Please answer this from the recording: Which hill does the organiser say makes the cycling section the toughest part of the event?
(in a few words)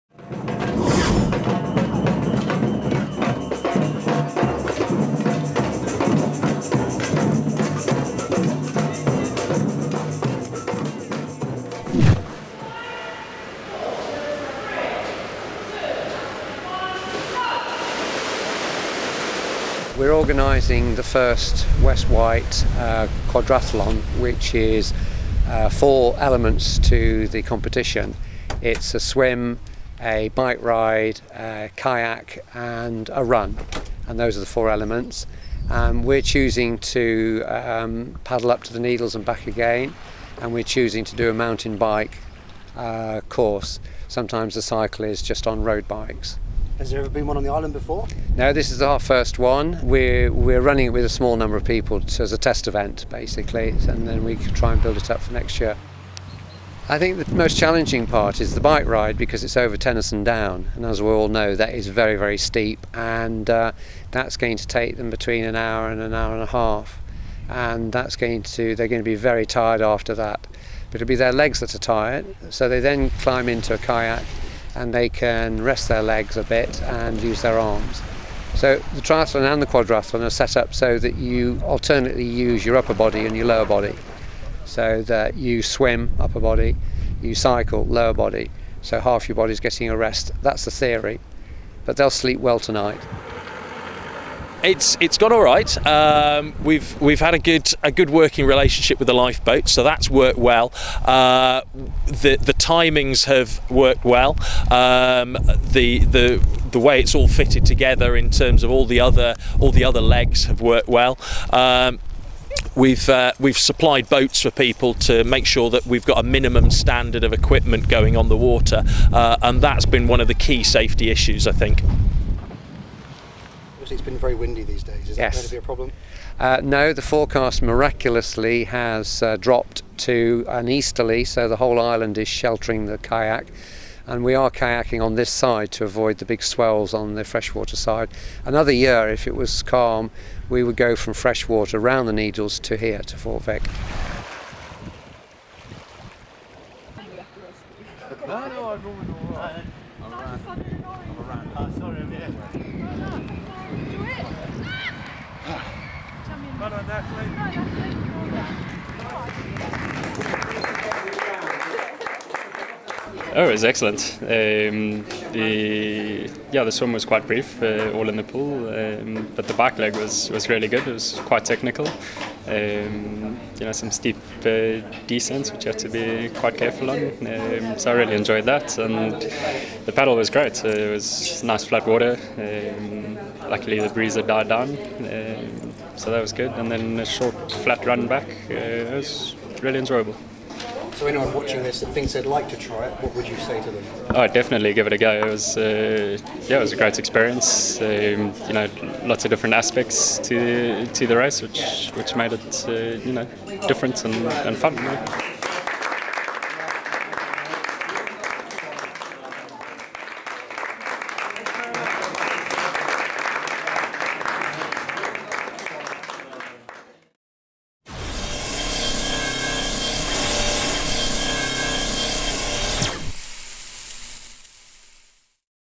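Tennyson Down.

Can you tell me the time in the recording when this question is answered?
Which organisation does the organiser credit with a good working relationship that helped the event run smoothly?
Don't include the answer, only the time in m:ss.
1:39.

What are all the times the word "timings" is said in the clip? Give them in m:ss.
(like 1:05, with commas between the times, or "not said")
1:42.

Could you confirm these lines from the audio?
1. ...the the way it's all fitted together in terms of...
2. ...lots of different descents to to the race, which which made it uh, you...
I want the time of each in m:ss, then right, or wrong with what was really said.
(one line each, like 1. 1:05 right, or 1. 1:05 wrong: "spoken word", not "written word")
1. 1:46 right
2. 3:19 wrong: "aspects", not "descents".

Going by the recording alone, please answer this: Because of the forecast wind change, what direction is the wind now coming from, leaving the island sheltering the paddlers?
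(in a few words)
Easterly.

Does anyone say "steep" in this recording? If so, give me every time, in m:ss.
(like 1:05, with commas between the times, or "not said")
1:02, 2:53.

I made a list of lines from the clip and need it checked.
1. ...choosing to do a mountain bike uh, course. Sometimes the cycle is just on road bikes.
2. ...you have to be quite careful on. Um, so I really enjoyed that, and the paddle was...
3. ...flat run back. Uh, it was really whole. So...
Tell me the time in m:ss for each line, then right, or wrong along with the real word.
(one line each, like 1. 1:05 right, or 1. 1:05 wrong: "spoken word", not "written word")
1. 0:40 right
2. 2:55 right
3. 3:07 wrong: "enjoyable", not "whole".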